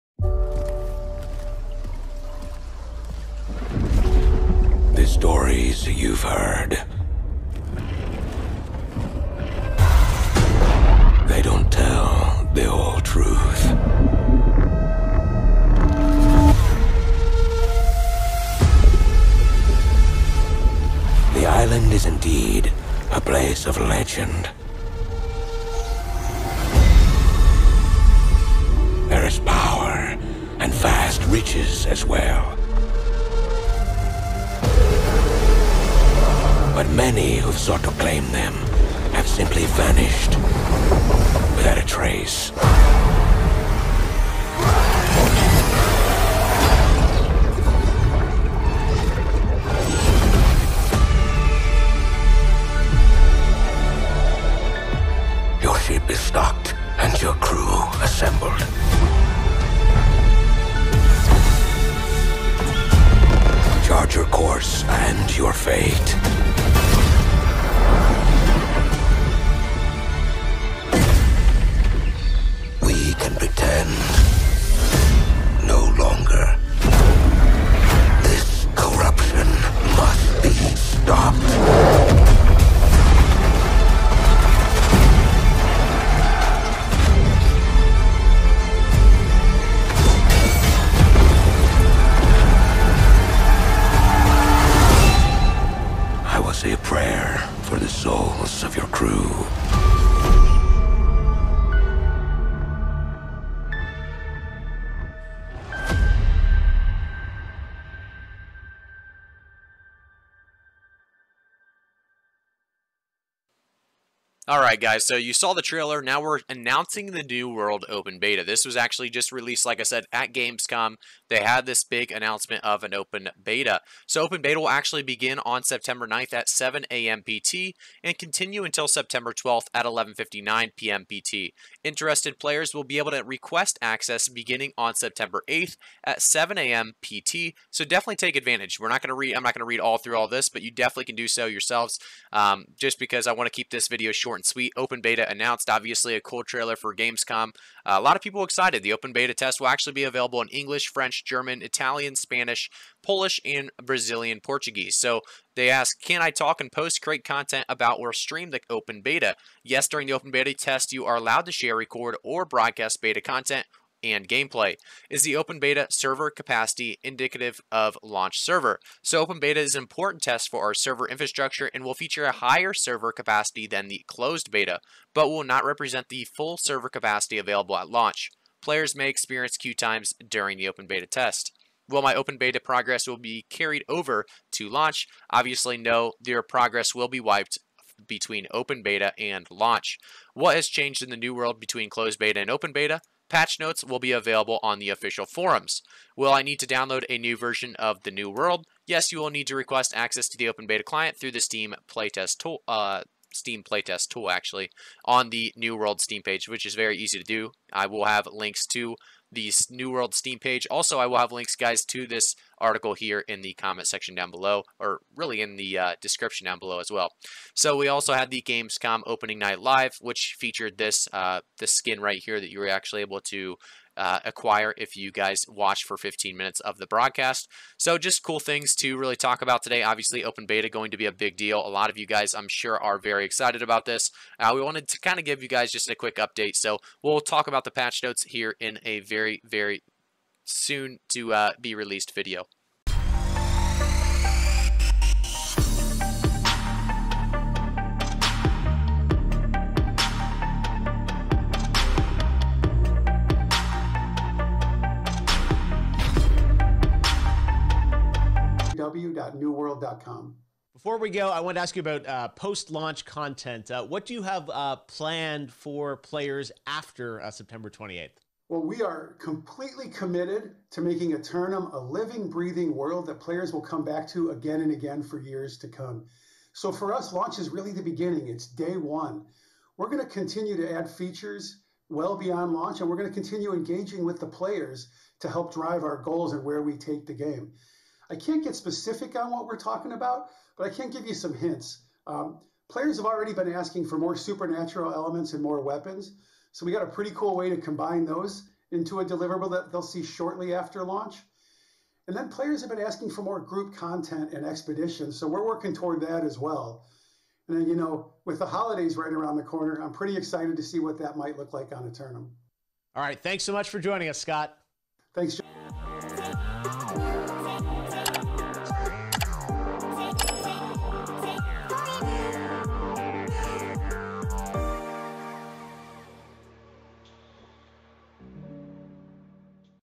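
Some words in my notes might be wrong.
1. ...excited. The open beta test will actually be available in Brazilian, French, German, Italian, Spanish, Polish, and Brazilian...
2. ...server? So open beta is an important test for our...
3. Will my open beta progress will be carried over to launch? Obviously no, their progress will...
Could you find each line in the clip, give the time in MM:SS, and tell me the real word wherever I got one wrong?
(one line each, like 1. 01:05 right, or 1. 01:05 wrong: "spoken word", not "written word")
1. 02:28 wrong: "English", not "Brazilian"
2. 02:48 right
3. 03:01 right.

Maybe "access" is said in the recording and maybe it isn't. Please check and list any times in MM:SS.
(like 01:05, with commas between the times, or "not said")
02:13, 03:19.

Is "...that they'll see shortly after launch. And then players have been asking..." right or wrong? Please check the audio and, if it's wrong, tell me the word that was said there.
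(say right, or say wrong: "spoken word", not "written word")
right.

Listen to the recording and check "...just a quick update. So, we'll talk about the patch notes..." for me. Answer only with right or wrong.
right.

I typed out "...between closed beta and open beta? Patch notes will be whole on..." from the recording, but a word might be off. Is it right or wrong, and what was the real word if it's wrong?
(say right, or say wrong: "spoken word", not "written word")
wrong: "available", not "whole".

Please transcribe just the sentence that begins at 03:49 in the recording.
Obviously, open beta going to be a big deal.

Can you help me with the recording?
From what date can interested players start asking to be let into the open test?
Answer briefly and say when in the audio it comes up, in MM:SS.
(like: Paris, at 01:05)
September 8th, at 02:14.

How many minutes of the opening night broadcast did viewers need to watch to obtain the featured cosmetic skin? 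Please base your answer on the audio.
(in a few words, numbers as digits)
15.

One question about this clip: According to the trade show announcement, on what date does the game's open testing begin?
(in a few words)
September 9th.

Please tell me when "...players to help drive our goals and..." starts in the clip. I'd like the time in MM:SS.
04:44.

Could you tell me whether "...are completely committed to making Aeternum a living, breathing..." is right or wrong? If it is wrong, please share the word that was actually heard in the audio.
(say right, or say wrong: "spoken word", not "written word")
right.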